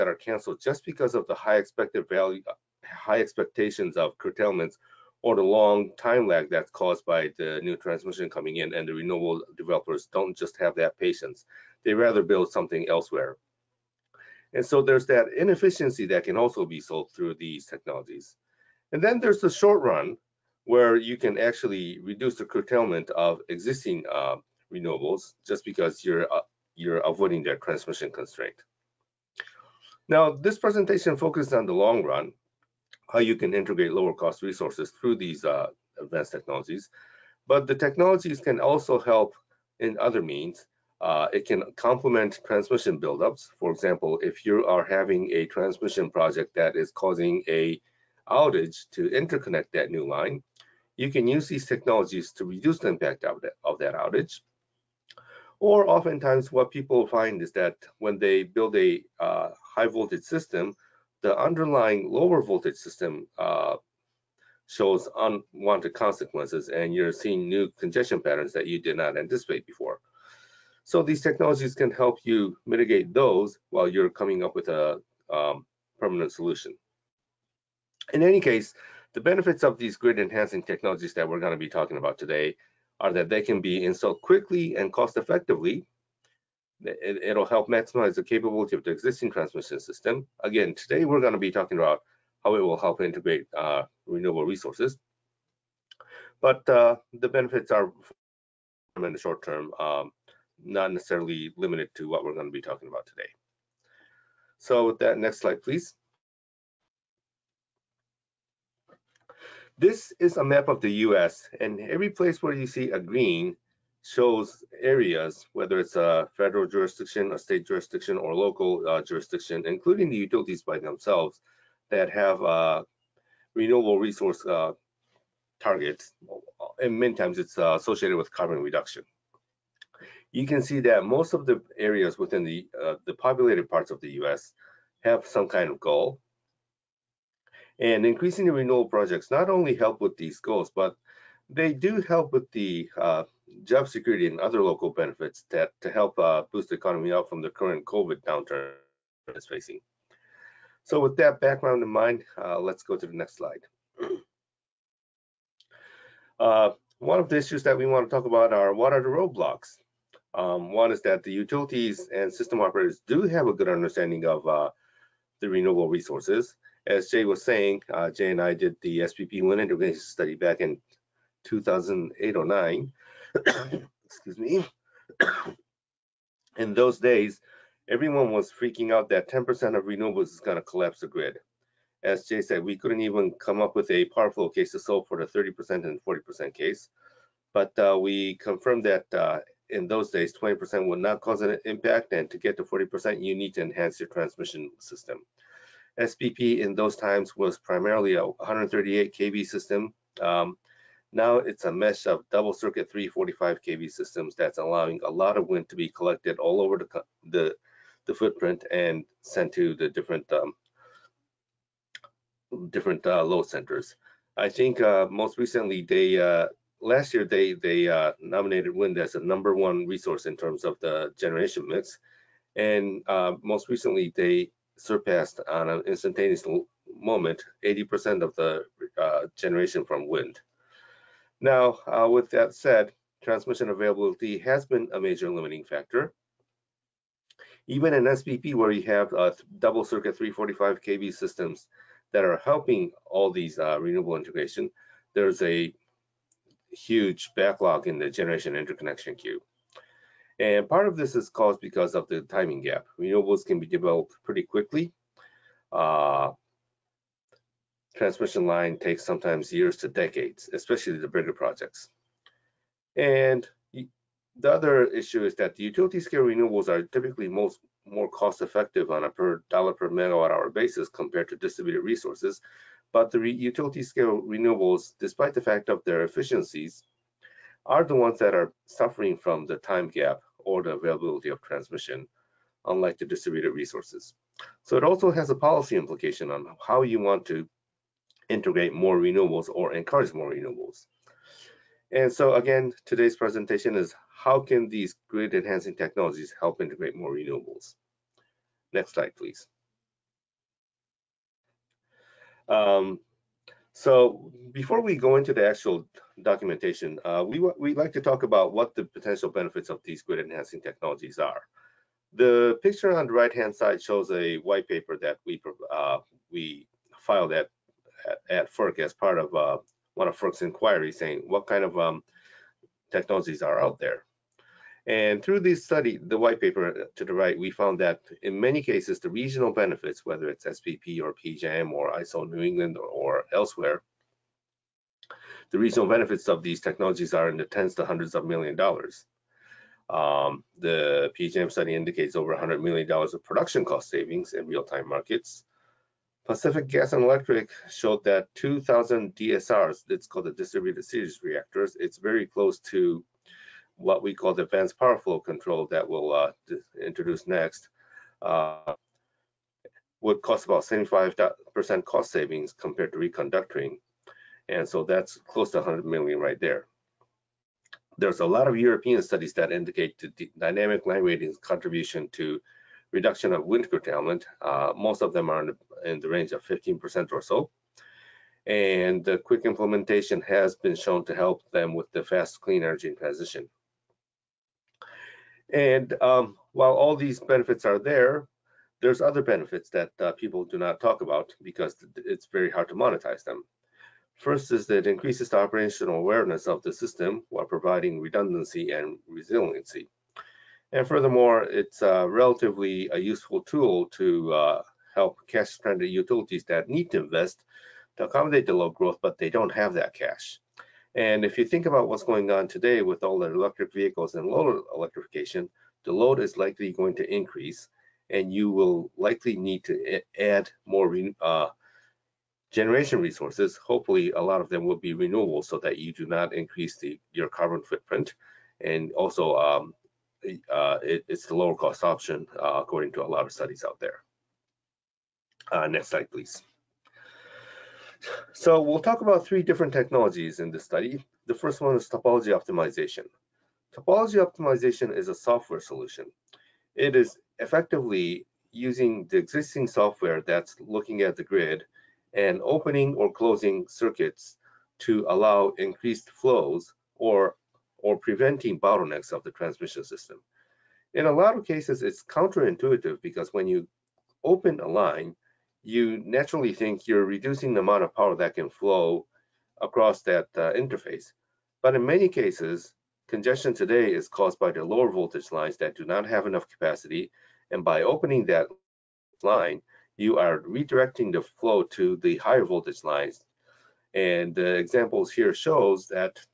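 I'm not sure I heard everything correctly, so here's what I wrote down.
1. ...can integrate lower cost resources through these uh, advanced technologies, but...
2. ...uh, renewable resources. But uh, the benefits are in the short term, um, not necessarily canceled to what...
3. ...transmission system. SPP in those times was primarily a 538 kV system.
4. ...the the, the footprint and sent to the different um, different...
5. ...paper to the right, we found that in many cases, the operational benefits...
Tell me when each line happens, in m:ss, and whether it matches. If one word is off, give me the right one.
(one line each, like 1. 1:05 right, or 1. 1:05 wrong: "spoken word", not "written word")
1. 0:33 right
2. 1:33 wrong: "limited", not "canceled"
3. 3:14 wrong: "138", not "538"
4. 3:26 right
5. 5:26 wrong: "regional", not "operational".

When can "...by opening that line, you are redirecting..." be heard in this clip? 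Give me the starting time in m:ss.
7:57.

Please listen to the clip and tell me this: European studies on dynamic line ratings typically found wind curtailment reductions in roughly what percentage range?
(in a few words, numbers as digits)
15%.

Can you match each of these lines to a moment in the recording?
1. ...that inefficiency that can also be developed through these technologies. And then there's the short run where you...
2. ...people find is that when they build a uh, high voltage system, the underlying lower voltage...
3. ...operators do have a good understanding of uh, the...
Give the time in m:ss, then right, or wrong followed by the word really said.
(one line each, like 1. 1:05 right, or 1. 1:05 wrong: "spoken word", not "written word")
1. 0:15 wrong: "solved", not "developed"
2. 0:56 right
3. 2:42 right.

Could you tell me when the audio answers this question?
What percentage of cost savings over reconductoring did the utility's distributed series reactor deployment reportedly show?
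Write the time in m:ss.
6:00.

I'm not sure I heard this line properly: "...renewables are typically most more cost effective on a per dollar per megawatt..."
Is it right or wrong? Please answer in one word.
right.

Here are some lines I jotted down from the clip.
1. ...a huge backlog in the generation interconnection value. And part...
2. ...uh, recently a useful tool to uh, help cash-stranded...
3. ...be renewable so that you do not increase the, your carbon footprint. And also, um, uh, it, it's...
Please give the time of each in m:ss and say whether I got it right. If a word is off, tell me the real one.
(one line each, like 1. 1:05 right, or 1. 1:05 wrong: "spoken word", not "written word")
1. 4:05 wrong: "queue", not "value"
2. 6:41 wrong: "relatively", not "recently"
3. 7:04 right.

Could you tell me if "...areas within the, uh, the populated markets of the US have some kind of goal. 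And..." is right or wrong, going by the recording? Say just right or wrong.
wrong.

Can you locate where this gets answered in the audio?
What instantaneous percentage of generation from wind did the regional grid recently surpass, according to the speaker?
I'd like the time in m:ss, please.
3:47.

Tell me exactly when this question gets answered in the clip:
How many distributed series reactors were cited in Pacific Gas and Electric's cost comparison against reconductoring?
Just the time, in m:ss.
5:48.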